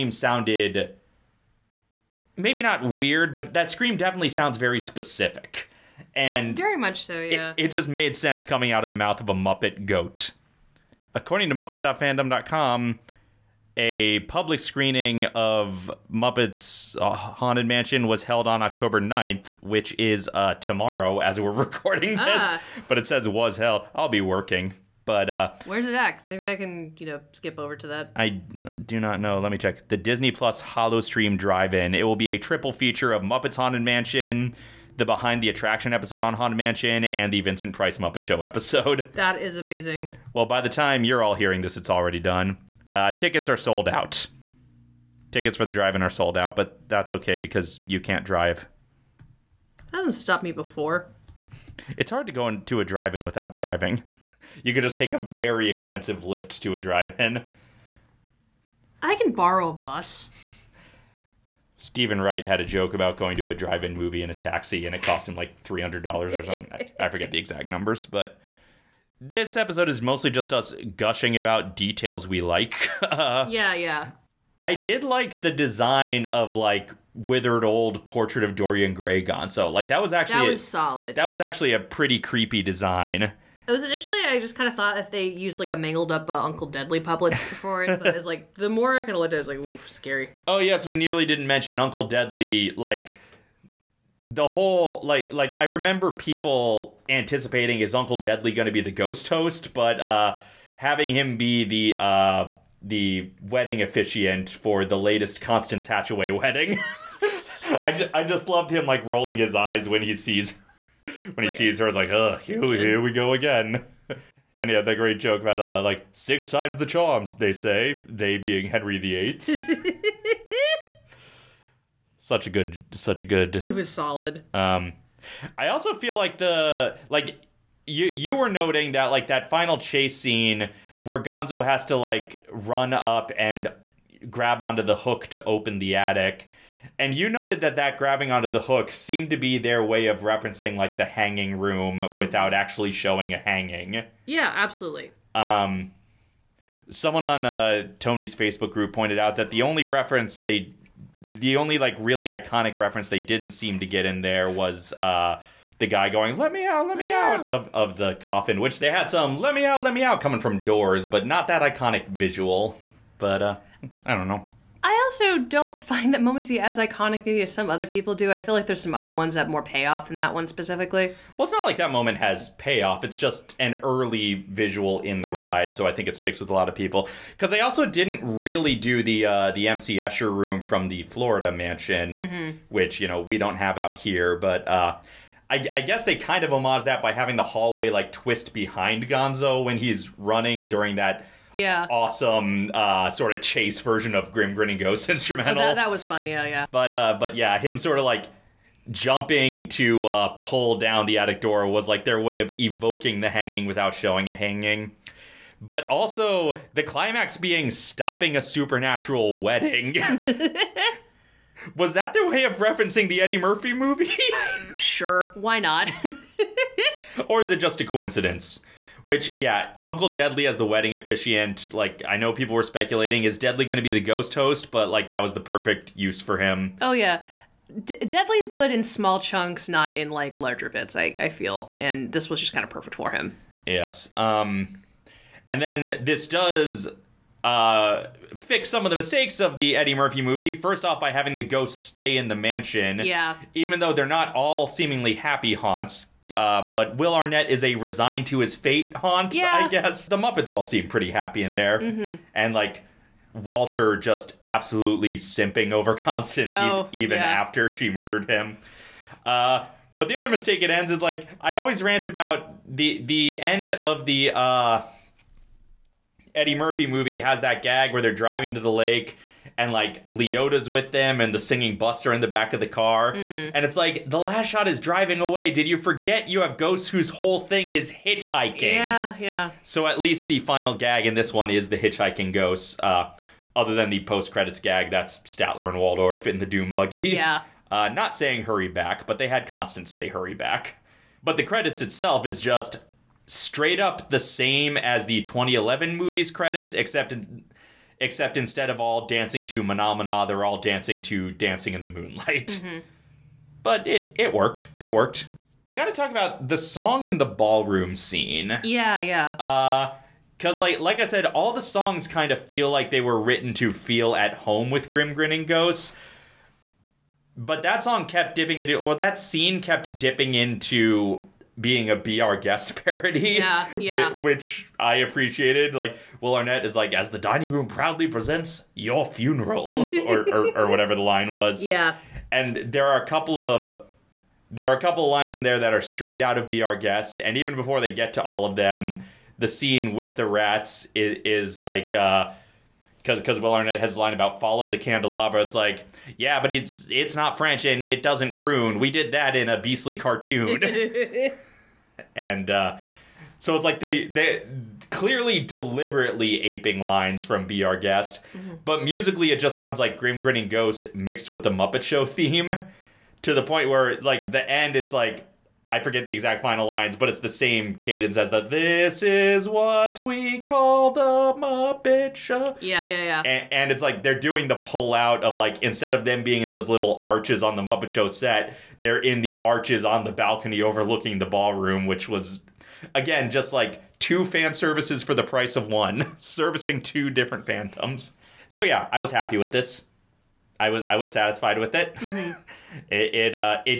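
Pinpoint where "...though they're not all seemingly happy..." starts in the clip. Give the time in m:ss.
4:03.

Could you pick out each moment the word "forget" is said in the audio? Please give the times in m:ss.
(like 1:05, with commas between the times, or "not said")
1:07, 4:35, 6:05.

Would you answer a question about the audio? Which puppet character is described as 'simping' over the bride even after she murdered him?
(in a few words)
Walter.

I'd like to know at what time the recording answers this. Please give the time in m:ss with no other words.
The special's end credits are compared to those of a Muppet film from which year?
4:55.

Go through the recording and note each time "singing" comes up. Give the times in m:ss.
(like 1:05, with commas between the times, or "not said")
4:31.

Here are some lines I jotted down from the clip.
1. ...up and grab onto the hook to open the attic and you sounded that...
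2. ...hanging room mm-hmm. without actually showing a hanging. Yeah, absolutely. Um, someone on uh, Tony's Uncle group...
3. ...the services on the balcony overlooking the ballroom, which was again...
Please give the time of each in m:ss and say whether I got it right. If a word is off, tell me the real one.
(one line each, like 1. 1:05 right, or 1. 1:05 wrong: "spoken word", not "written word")
1. 2:12 wrong: "noted", not "sounded"
2. 2:21 wrong: "Facebook", not "Uncle"
3. 6:19 wrong: "arches", not "services".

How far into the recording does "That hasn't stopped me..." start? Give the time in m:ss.
0:49.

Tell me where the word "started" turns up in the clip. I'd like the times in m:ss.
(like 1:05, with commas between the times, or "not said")
not said.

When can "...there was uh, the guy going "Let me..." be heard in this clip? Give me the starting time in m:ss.
2:34.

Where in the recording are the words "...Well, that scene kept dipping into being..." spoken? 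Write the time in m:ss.
5:18.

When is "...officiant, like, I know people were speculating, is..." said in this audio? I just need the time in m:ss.
3:40.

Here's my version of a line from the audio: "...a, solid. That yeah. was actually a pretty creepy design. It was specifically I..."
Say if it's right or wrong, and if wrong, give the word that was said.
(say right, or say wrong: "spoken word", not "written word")
wrong: "initially", not "specifically".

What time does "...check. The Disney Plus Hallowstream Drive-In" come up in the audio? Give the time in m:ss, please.
0:29.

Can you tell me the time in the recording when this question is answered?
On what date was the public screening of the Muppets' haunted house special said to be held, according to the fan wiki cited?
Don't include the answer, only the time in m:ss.
0:18.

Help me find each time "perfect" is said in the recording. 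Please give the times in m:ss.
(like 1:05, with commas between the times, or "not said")
3:45, 3:52.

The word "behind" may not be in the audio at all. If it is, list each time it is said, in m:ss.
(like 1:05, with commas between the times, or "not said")
0:35, 3:08.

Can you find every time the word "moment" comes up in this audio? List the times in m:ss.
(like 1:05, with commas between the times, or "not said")
2:46, 2:51.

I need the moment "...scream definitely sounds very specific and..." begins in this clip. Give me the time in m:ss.
0:03.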